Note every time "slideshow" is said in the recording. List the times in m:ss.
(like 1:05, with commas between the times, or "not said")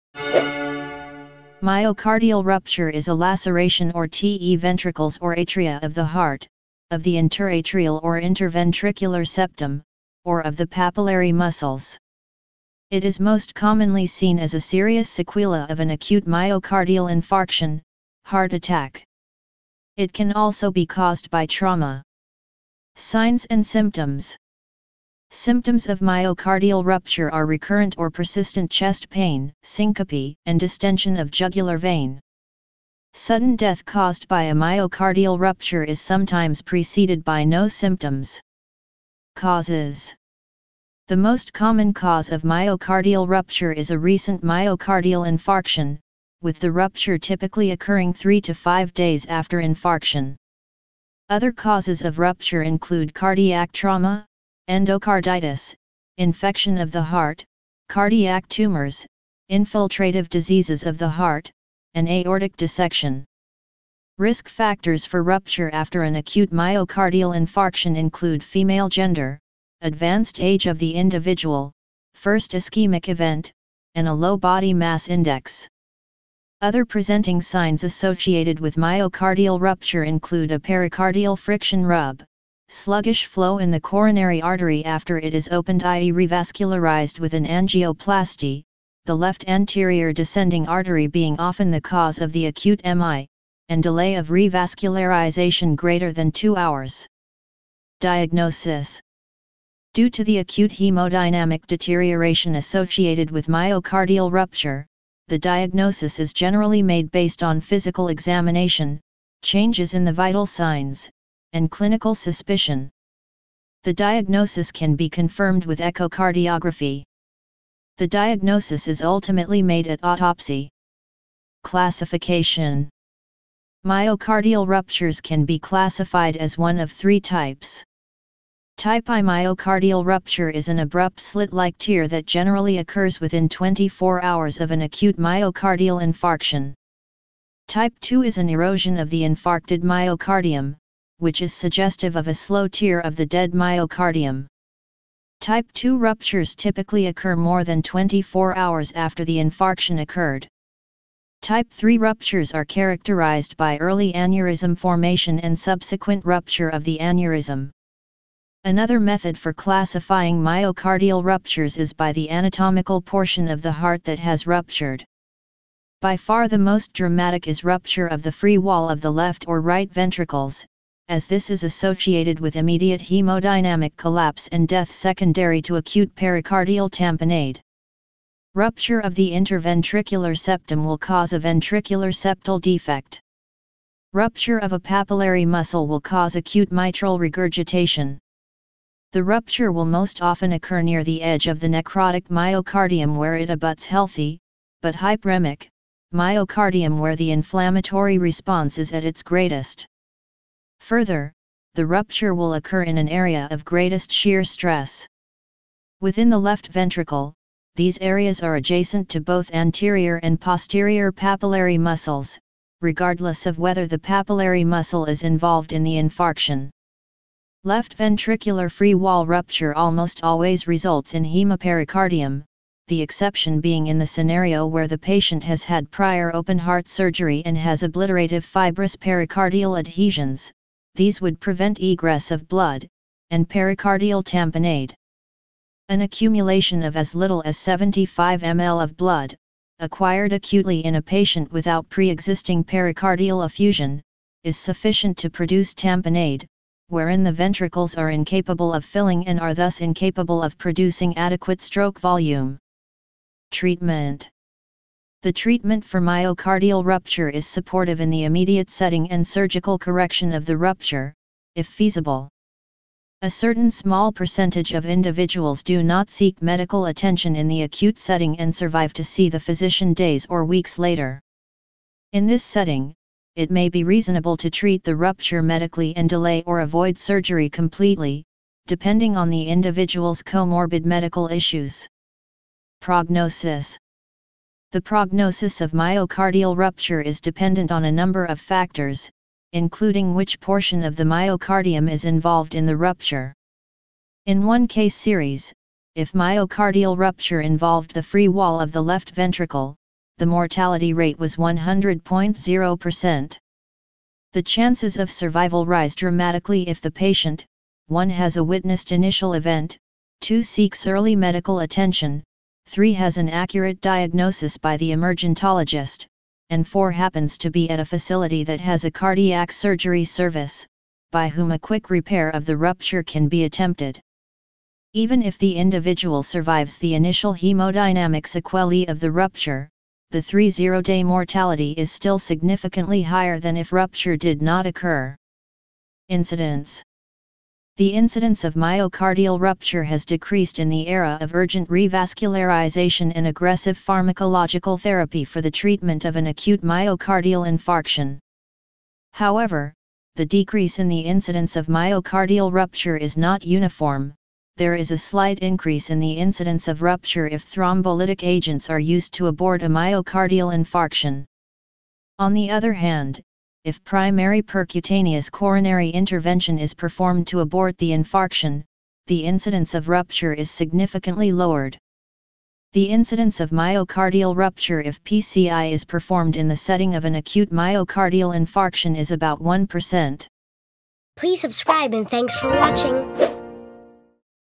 not said.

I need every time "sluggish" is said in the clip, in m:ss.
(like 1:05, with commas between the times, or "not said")
1:22.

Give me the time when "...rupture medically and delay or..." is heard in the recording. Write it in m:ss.
4:34.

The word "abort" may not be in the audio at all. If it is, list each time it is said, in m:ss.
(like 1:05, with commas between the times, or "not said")
5:59, 6:07.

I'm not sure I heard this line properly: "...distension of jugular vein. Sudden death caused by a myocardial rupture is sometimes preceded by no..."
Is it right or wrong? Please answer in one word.
right.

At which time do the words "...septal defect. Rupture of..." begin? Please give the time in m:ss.
3:02.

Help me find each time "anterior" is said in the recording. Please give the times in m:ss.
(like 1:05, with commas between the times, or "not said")
1:29, 3:29.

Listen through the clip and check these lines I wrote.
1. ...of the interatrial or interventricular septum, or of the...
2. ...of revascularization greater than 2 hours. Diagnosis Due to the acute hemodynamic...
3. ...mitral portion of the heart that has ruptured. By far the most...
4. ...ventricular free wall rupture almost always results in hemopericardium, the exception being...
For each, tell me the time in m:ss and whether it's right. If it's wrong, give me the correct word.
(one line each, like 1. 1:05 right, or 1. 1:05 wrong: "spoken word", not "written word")
1. 0:06 right
2. 1:34 right
3. 2:42 wrong: "anatomical", not "mitral"
4. 3:37 right.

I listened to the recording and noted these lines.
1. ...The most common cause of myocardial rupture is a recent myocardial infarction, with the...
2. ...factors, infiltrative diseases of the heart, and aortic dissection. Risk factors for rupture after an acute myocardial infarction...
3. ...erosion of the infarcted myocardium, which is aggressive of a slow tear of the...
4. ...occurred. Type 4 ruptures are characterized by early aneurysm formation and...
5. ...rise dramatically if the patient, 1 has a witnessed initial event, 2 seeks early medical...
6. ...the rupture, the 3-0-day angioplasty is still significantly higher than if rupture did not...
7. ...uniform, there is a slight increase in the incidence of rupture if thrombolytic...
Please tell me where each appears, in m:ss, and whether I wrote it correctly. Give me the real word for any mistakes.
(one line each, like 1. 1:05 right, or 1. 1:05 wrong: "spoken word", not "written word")
1. 0:41 right
2. 0:58 wrong: "tumors", not "factors"
3. 2:18 wrong: "suggestive", not "aggressive"
4. 2:30 wrong: "3", not "4"
5. 5:05 right
6. 5:29 wrong: "mortality", not "angioplasty"
7. 5:53 right.